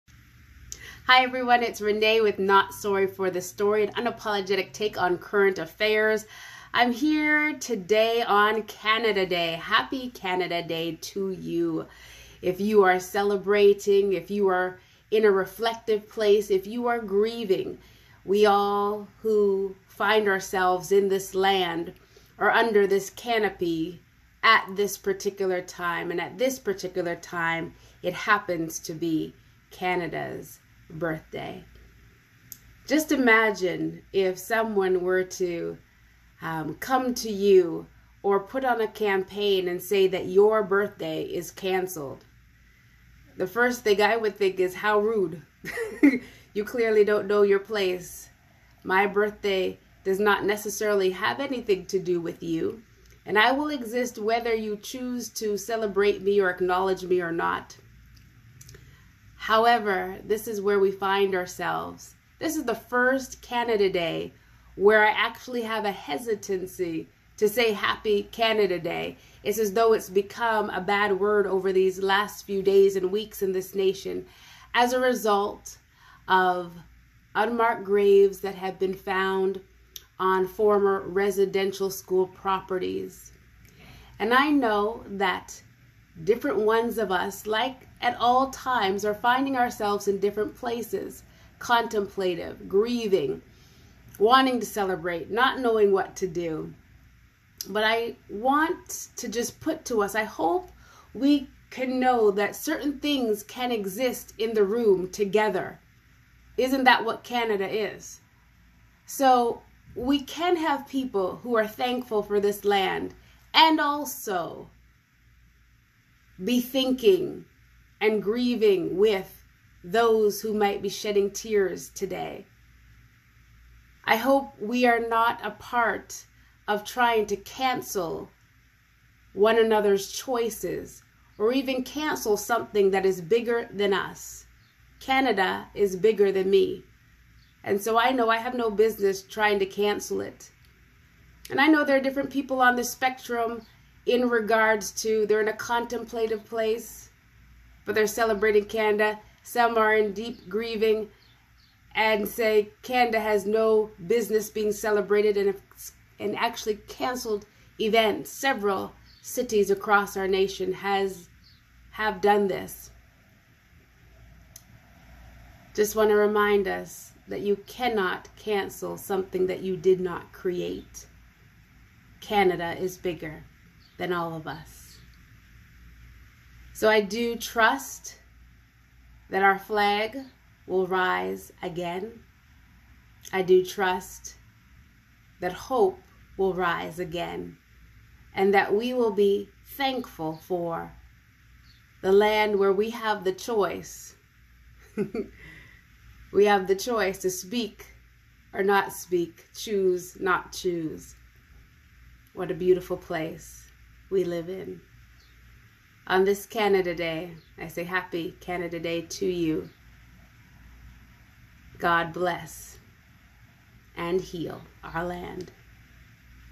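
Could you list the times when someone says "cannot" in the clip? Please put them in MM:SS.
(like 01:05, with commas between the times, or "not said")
02:47.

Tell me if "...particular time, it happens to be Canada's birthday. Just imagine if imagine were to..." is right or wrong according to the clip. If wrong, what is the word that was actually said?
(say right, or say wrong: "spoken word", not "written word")
wrong: "someone", not "imagine".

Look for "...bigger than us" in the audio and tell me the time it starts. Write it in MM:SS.
02:13.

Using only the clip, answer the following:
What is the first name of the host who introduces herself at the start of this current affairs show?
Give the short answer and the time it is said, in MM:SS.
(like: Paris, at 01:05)
Renae, at 00:01.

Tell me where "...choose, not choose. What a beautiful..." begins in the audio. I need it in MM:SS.
03:19.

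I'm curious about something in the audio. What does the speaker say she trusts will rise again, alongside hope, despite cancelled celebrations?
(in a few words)
our flag.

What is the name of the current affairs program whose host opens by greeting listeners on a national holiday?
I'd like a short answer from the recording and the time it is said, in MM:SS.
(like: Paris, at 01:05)
Not Sorry for the Story, at 00:02.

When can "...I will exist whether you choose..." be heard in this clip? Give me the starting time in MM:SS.
00:53.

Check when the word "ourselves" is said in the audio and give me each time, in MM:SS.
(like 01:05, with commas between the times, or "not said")
00:20, 01:01, 01:29.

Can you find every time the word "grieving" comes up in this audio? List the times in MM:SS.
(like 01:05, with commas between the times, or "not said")
00:16, 01:32, 01:58, 02:30.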